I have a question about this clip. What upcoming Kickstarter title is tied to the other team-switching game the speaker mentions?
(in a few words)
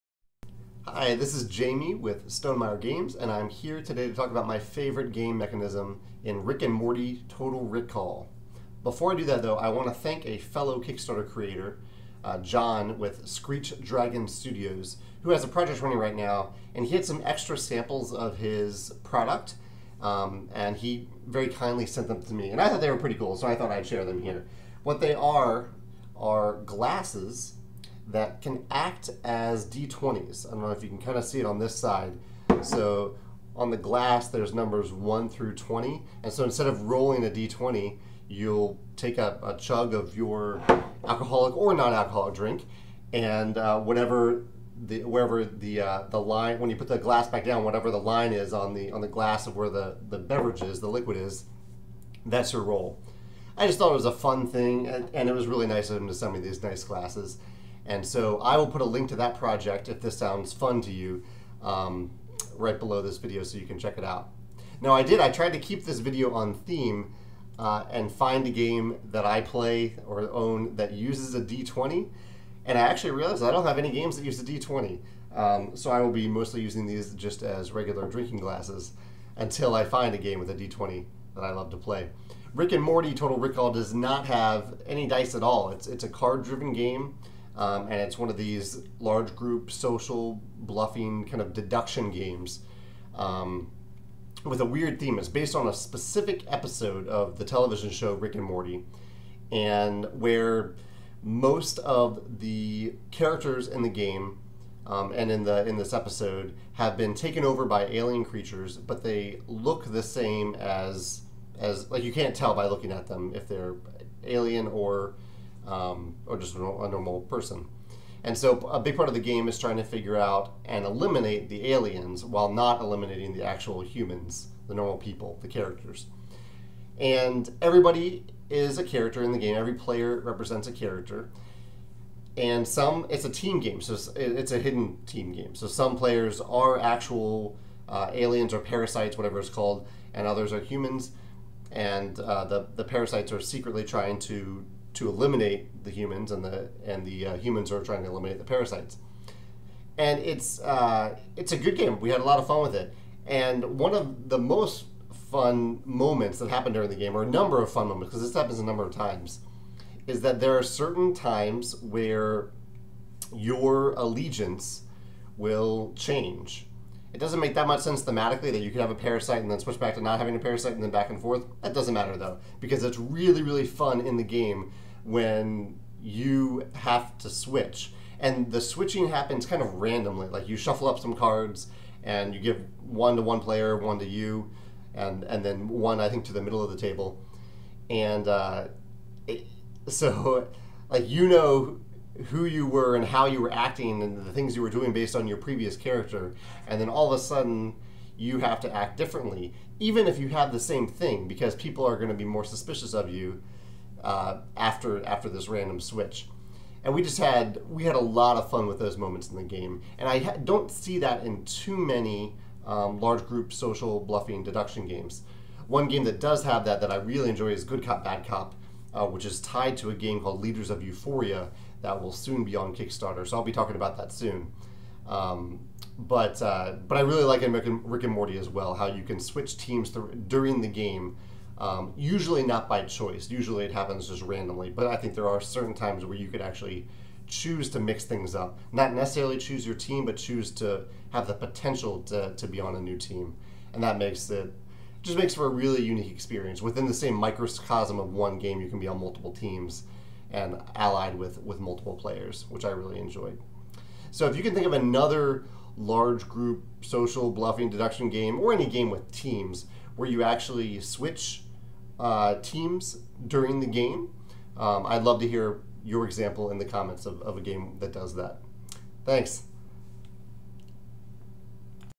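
Leaders of Euphoria.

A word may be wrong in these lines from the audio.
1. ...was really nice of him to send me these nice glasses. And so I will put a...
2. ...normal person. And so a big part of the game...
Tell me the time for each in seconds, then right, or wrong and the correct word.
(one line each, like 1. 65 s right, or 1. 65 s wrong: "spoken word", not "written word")
1. 55 s right
2. 116 s right.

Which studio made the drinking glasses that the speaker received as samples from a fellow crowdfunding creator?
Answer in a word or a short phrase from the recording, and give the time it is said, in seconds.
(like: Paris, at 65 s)
Screech Dragon Studios, at 13 s.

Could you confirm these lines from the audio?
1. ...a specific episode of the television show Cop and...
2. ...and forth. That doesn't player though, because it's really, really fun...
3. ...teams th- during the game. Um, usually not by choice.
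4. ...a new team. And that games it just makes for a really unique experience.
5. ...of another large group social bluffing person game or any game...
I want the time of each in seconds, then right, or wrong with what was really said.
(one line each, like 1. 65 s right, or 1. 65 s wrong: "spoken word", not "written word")
1. 95 s wrong: "Rick", not "Cop"
2. 171 s wrong: "matter", not "player"
3. 229 s right
4. 242 s wrong: "makes", not "games"
5. 254 s wrong: "deduction", not "person".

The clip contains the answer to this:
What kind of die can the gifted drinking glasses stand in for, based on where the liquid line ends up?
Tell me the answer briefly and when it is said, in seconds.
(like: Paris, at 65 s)
D20, at 29 s.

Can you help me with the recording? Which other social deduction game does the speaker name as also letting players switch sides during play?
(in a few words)
Good Cop Bad Cop.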